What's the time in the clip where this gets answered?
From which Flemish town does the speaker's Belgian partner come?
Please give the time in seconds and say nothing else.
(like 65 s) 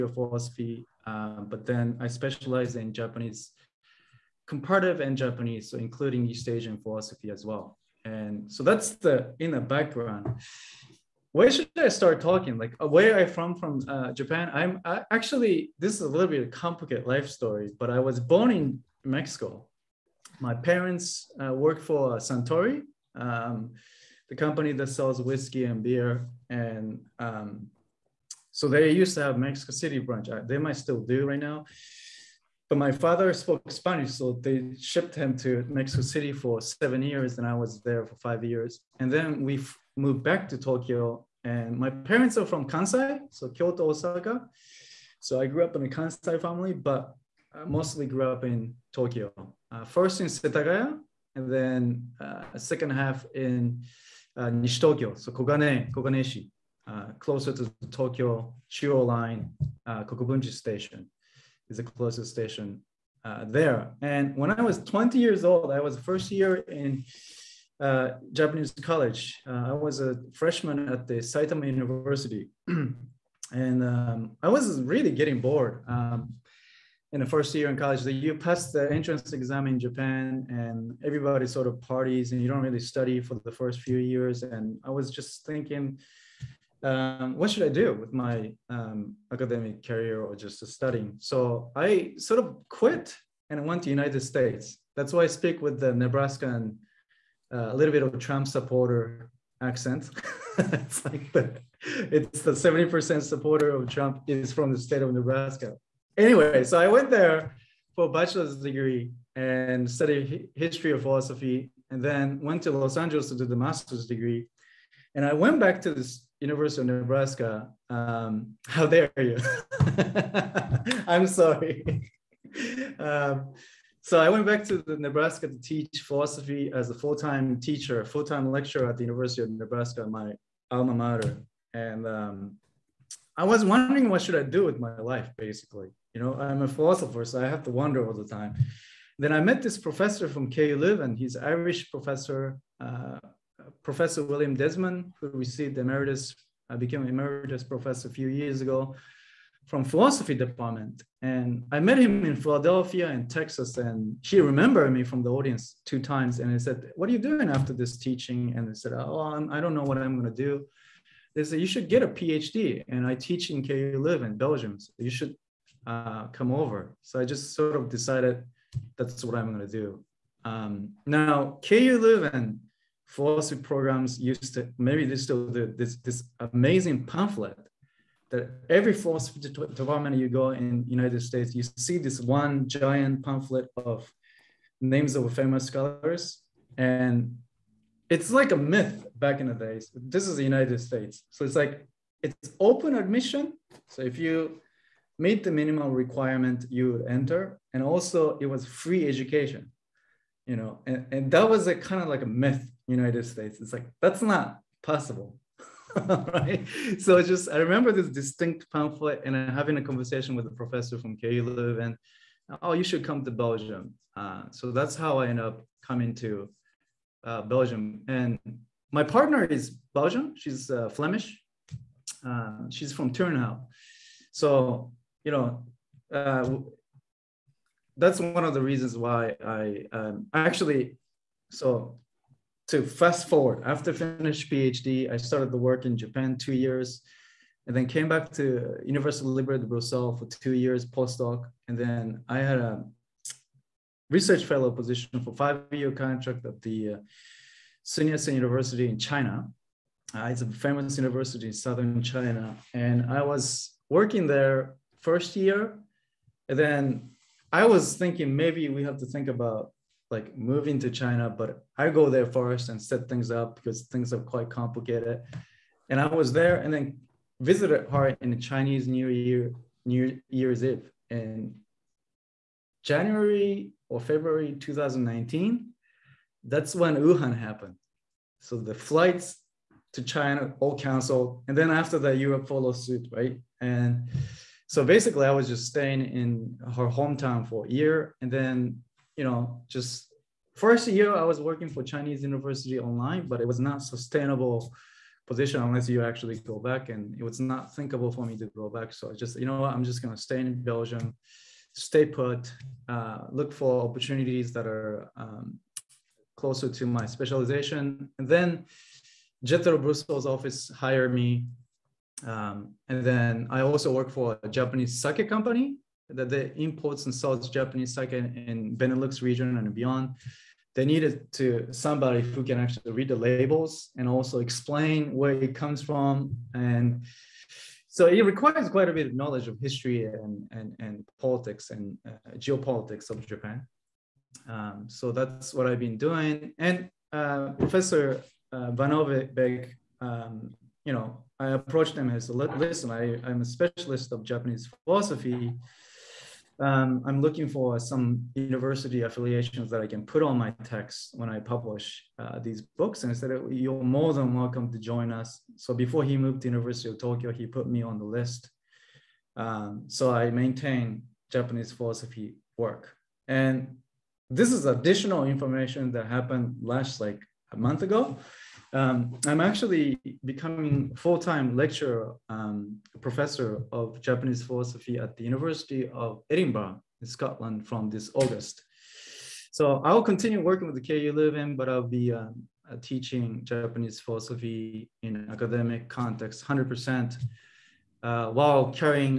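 223 s.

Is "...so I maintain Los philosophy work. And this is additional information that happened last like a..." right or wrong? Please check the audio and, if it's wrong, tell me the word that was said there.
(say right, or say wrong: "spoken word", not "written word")
wrong: "Japanese", not "Los".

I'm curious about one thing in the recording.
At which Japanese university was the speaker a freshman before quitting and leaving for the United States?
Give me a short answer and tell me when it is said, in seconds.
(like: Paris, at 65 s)
Saitama University, at 71 s.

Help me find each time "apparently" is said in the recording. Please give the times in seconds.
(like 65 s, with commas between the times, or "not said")
not said.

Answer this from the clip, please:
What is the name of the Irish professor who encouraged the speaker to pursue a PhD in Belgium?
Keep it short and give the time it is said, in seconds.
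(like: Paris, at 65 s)
William Desmond, at 144 s.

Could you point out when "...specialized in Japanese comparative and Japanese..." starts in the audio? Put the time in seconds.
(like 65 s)
2 s.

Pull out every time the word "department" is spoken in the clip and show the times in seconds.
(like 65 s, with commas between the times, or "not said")
150 s, 179 s.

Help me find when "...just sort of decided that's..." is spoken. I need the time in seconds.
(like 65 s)
167 s.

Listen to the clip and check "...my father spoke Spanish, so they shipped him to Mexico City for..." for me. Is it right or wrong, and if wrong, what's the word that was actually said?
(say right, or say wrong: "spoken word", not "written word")
right.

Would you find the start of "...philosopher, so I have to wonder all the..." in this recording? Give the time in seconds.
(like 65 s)
136 s.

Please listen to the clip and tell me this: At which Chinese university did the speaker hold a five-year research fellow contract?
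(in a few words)
Sun Yat-sen University.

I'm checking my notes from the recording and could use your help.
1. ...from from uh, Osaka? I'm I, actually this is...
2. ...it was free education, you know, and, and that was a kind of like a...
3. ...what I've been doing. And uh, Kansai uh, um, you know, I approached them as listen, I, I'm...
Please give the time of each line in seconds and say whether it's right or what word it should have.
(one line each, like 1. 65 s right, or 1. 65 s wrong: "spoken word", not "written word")
1. 13 s wrong: "Japan", not "Osaka"
2. 198 s right
3. 335 s wrong: "Professor", not "Kansai".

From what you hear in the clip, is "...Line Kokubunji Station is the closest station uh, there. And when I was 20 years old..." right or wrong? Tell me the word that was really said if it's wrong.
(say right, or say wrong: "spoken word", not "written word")
right.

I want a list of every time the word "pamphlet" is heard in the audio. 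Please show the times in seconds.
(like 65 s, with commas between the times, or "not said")
177 s, 183 s, 208 s.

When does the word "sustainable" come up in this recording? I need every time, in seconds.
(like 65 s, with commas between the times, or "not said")
293 s.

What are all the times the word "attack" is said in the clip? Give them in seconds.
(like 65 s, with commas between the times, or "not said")
not said.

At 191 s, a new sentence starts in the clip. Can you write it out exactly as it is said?
So it's like, it's open admission.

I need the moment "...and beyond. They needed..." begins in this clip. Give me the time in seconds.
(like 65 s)
319 s.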